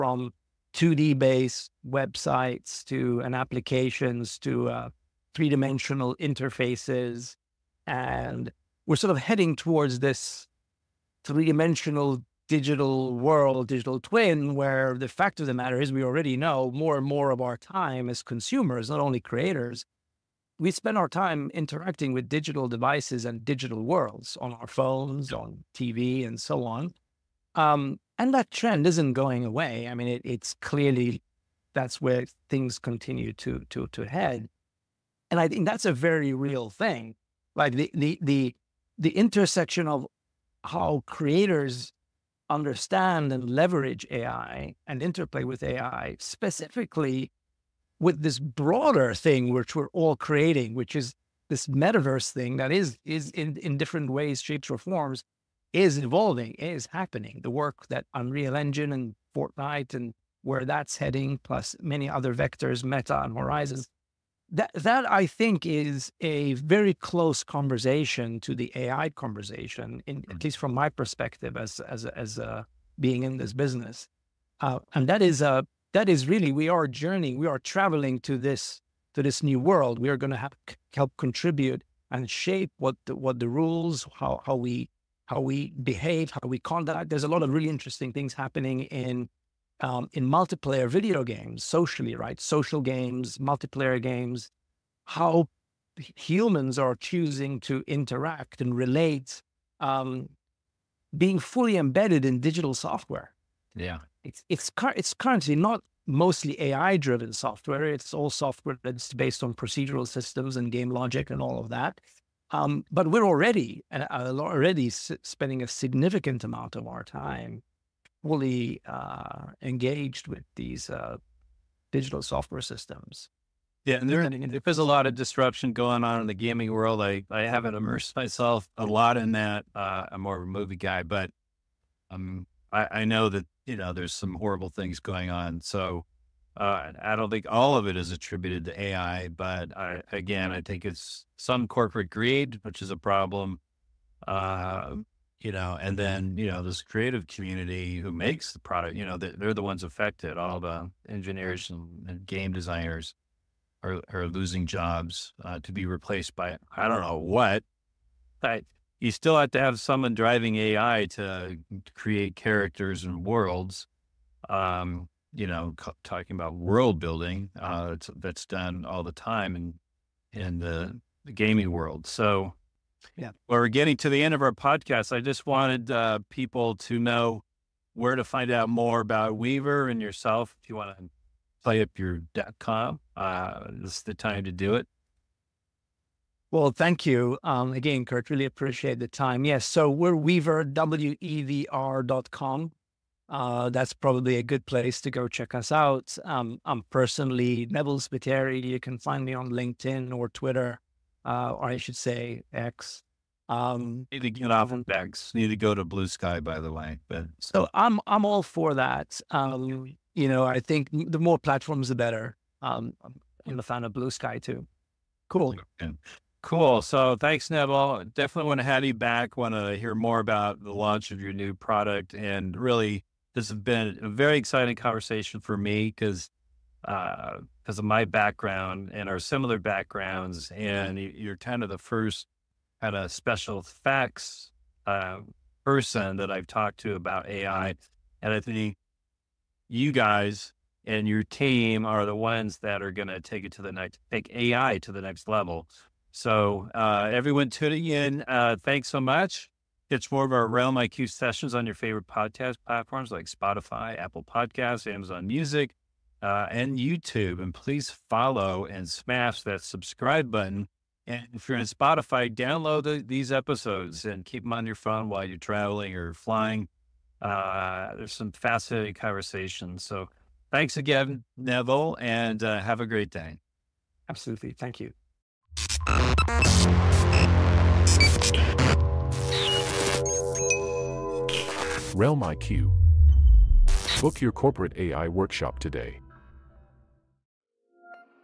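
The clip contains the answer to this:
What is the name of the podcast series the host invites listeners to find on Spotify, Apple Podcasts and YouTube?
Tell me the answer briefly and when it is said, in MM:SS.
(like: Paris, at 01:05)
RealmIQ sessions, at 04:10.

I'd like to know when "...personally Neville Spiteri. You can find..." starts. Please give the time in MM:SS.
03:16.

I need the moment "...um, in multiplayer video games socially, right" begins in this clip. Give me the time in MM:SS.
01:29.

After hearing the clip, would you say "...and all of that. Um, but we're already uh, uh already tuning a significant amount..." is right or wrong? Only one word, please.
wrong.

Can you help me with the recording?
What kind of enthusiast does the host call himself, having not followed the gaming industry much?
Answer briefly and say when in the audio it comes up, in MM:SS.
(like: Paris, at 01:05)
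a movie guy, at 02:10.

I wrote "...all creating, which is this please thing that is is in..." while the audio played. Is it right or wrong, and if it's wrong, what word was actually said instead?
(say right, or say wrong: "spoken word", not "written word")
wrong: "metaverse", not "please".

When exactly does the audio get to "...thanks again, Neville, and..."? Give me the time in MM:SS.
04:30.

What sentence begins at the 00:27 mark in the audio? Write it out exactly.
Um, and that trend isn't going away.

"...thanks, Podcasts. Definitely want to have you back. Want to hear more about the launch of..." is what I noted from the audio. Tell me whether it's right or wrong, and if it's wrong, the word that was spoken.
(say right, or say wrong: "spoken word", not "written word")
wrong: "Neville", not "Podcasts".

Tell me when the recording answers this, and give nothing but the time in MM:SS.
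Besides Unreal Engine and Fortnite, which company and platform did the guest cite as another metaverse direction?
01:02.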